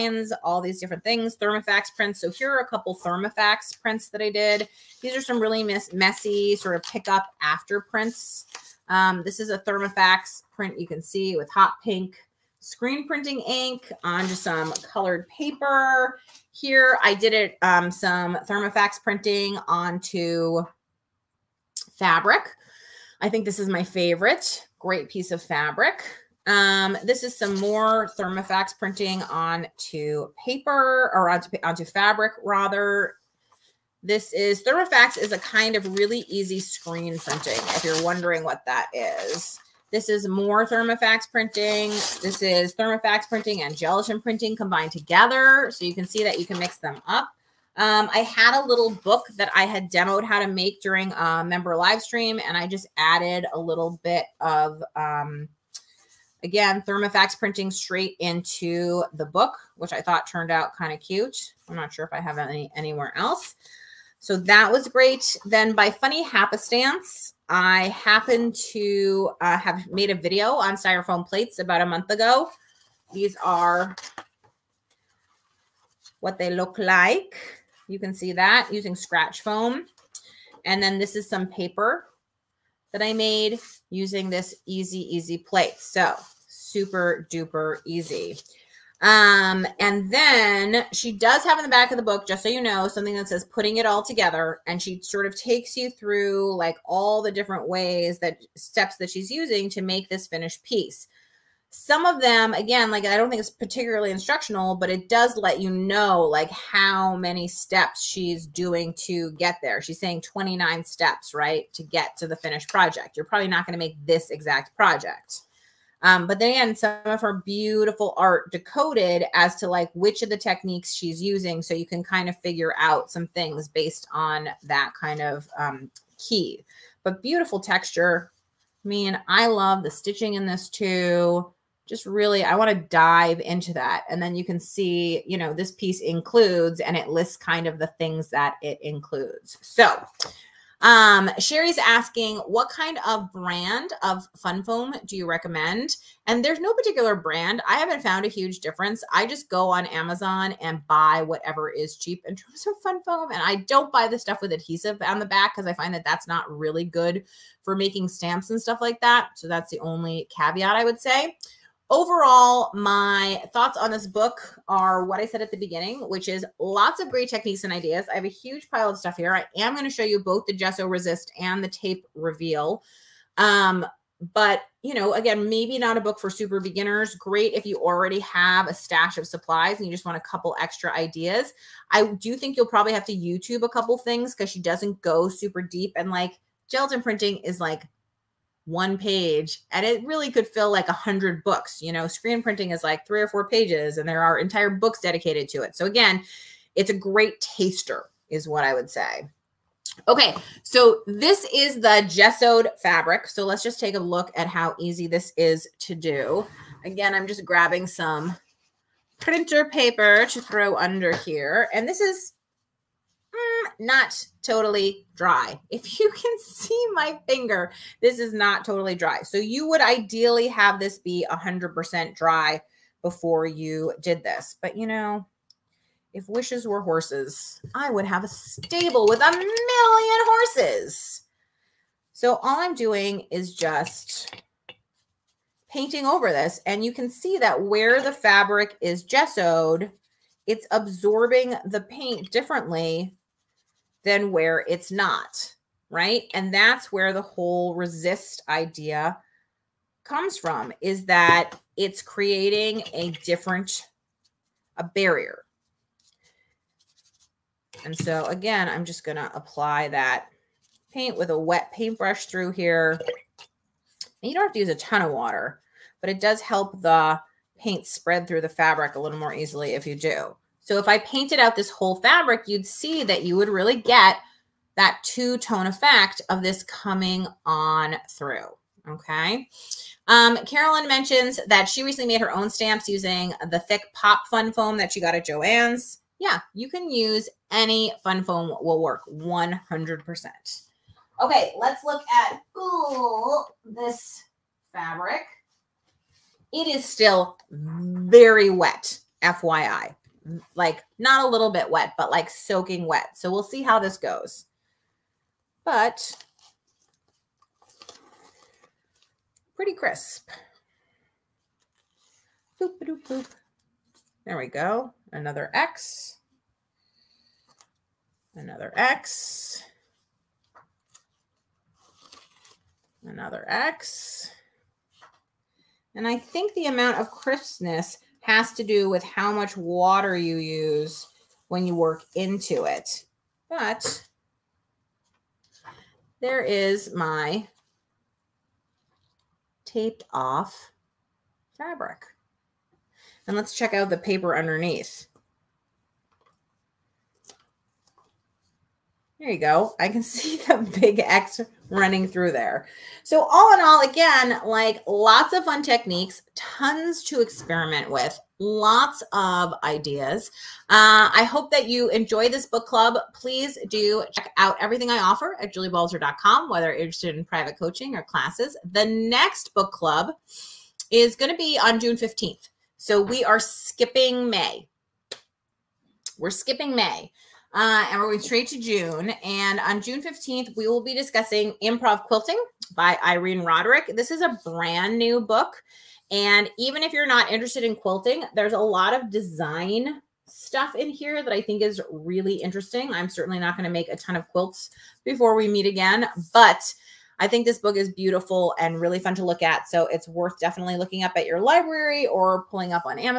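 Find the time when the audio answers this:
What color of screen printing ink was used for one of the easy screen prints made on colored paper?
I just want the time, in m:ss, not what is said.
0:11.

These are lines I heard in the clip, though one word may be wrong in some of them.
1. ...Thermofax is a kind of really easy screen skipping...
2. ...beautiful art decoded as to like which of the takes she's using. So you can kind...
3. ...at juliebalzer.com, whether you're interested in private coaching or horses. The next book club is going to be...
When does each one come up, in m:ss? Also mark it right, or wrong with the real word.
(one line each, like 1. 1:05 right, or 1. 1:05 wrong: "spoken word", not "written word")
1. 0:34 wrong: "printing", not "skipping"
2. 1:57 wrong: "techniques", not "takes"
3. 6:05 wrong: "classes", not "horses".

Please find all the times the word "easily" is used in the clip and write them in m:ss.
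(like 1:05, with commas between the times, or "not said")
4:29.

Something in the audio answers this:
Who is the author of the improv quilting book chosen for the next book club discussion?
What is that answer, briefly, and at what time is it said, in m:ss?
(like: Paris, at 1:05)
Irene Roderick, at 6:23.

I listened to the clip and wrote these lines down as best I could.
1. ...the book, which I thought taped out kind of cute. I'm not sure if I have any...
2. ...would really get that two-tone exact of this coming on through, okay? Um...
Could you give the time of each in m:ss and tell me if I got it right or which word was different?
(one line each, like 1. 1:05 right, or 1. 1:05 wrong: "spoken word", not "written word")
1. 0:59 wrong: "turned", not "taped"
2. 4:33 wrong: "effect", not "exact".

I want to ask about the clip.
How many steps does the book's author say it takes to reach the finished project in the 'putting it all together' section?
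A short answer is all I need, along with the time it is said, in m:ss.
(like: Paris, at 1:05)
29, at 1:50.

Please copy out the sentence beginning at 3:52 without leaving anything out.
So all I'm doing is just painting over this.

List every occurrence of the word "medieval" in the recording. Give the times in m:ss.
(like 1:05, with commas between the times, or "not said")
not said.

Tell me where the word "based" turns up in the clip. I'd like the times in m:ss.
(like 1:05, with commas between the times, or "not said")
2:03.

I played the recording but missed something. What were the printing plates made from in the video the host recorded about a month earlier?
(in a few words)
styrofoam plates.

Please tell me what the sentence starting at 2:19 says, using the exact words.
So um, Sherry's asking, what kind of brand of fun foam do you recommend?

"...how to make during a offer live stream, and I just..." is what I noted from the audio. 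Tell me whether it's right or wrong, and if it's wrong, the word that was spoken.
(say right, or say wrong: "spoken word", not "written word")
wrong: "member", not "offer".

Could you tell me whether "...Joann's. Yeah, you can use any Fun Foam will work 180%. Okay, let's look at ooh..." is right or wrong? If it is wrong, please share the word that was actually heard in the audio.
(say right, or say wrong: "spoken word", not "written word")
wrong: "100", not "180".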